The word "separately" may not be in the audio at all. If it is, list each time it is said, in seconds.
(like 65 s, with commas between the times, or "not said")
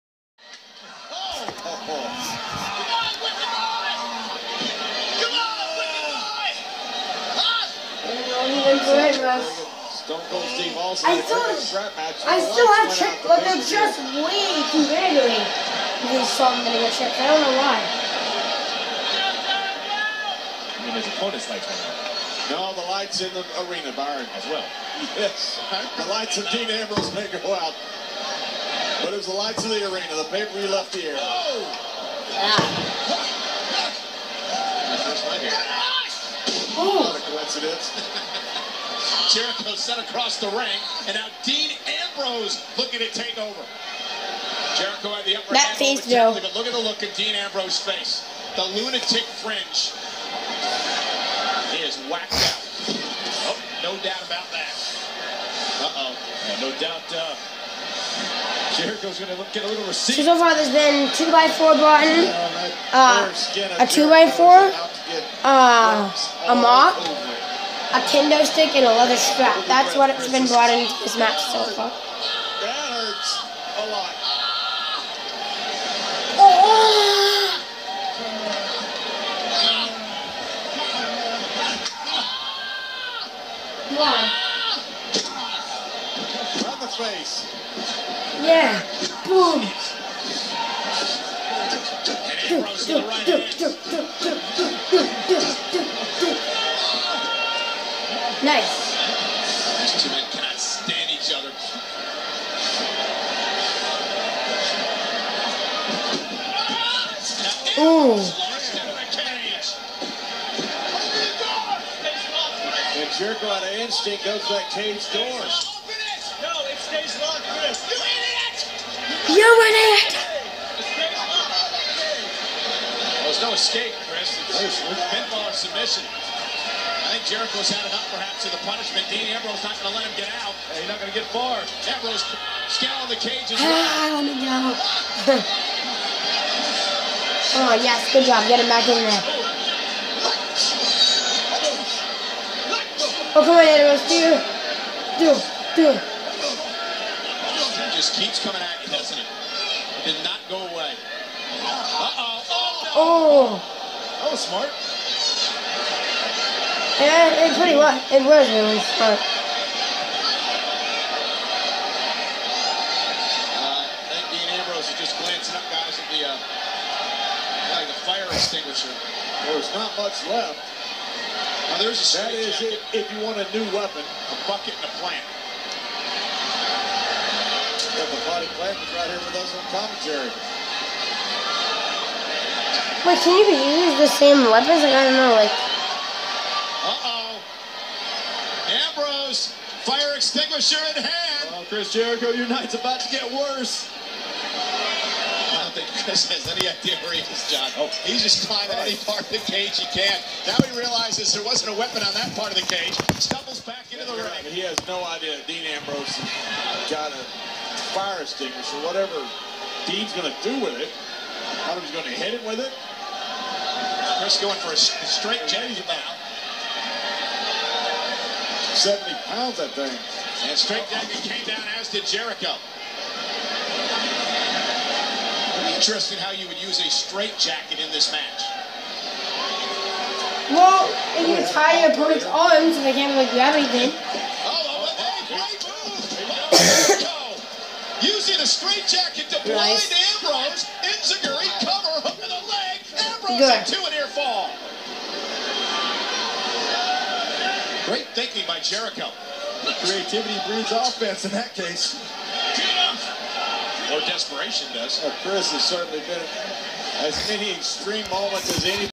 not said.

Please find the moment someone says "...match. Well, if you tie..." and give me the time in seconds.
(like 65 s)
228 s.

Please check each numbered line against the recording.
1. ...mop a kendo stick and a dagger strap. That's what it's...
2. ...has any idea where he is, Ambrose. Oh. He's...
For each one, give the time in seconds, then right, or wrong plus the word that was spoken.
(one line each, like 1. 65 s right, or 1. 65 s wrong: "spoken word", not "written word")
1. 66 s wrong: "leather", not "dagger"
2. 196 s wrong: "John", not "Ambrose".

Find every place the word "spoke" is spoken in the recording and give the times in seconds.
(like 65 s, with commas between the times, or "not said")
not said.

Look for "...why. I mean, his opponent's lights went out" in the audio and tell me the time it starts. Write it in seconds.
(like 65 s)
17 s.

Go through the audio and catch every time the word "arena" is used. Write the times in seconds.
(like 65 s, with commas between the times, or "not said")
23 s, 29 s.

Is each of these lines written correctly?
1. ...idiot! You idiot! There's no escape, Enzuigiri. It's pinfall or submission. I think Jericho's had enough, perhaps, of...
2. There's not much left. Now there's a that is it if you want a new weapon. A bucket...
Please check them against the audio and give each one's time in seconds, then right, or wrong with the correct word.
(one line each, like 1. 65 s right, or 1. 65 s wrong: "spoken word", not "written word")
1. 119 s wrong: "Chris", not "Enzuigiri"
2. 169 s right.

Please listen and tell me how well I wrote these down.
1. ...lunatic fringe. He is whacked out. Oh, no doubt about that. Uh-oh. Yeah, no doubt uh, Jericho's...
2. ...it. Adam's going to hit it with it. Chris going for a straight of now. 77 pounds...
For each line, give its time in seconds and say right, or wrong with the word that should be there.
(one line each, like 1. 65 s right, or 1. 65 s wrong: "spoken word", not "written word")
1. 48 s right
2. 210 s wrong: "70", not "77".